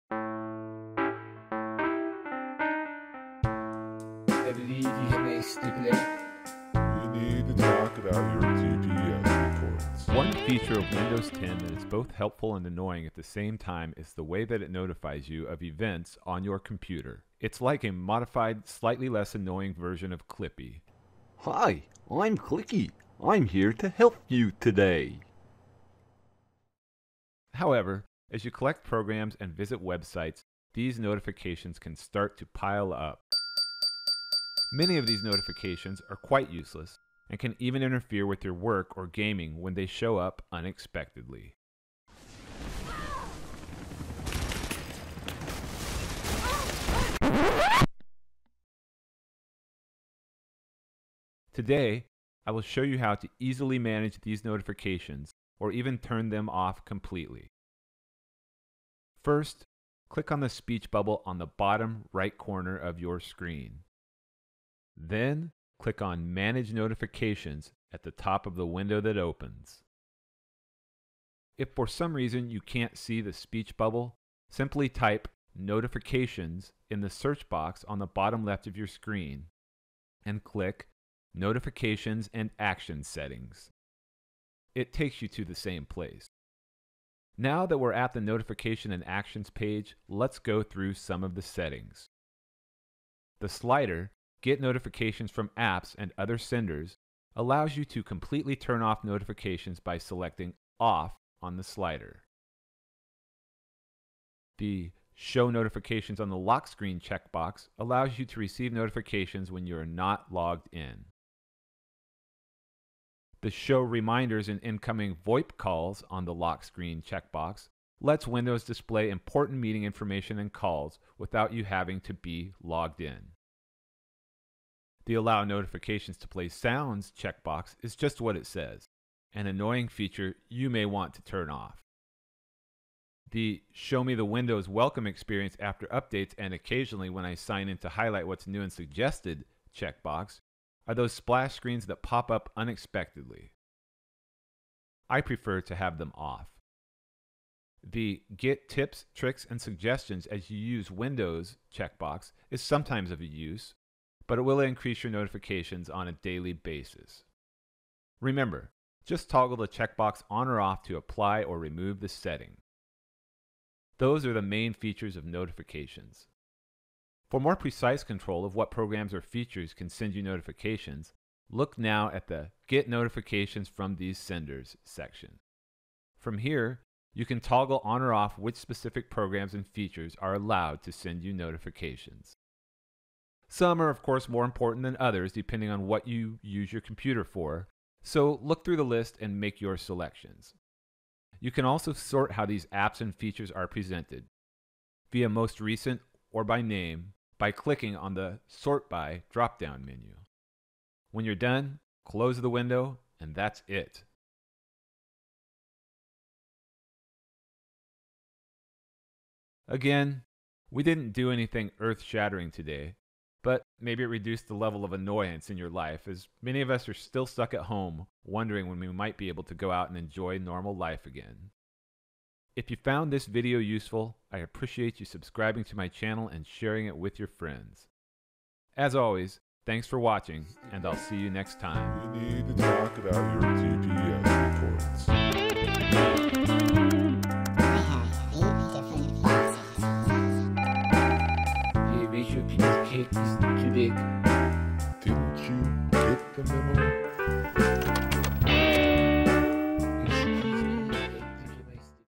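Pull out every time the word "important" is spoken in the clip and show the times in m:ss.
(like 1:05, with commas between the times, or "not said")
1:59, 3:04.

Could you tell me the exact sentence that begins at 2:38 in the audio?
Remember, just toggle the checkbox on or off to apply or remove the setting.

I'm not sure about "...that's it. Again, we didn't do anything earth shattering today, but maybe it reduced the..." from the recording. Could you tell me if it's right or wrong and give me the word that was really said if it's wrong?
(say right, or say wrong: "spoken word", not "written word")
right.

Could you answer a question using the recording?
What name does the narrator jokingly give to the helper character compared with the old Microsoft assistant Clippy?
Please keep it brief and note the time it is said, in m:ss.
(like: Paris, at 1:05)
Clicky, at 0:22.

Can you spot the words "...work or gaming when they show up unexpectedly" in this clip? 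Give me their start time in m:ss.
0:38.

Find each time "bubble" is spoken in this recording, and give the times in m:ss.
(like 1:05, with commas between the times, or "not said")
1:00, 1:13.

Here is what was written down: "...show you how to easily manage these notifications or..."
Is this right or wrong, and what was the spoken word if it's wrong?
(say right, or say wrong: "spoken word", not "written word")
right.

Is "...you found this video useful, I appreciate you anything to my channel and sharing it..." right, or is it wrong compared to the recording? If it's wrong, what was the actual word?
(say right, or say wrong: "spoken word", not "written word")
wrong: "subscribing", not "anything".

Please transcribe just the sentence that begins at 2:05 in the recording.
The Allow Notifications to Play Sounds checkbox is just what it says, an annoying feature you may want to turn off.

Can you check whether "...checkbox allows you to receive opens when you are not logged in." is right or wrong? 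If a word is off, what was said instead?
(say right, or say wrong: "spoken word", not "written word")
wrong: "notifications", not "opens".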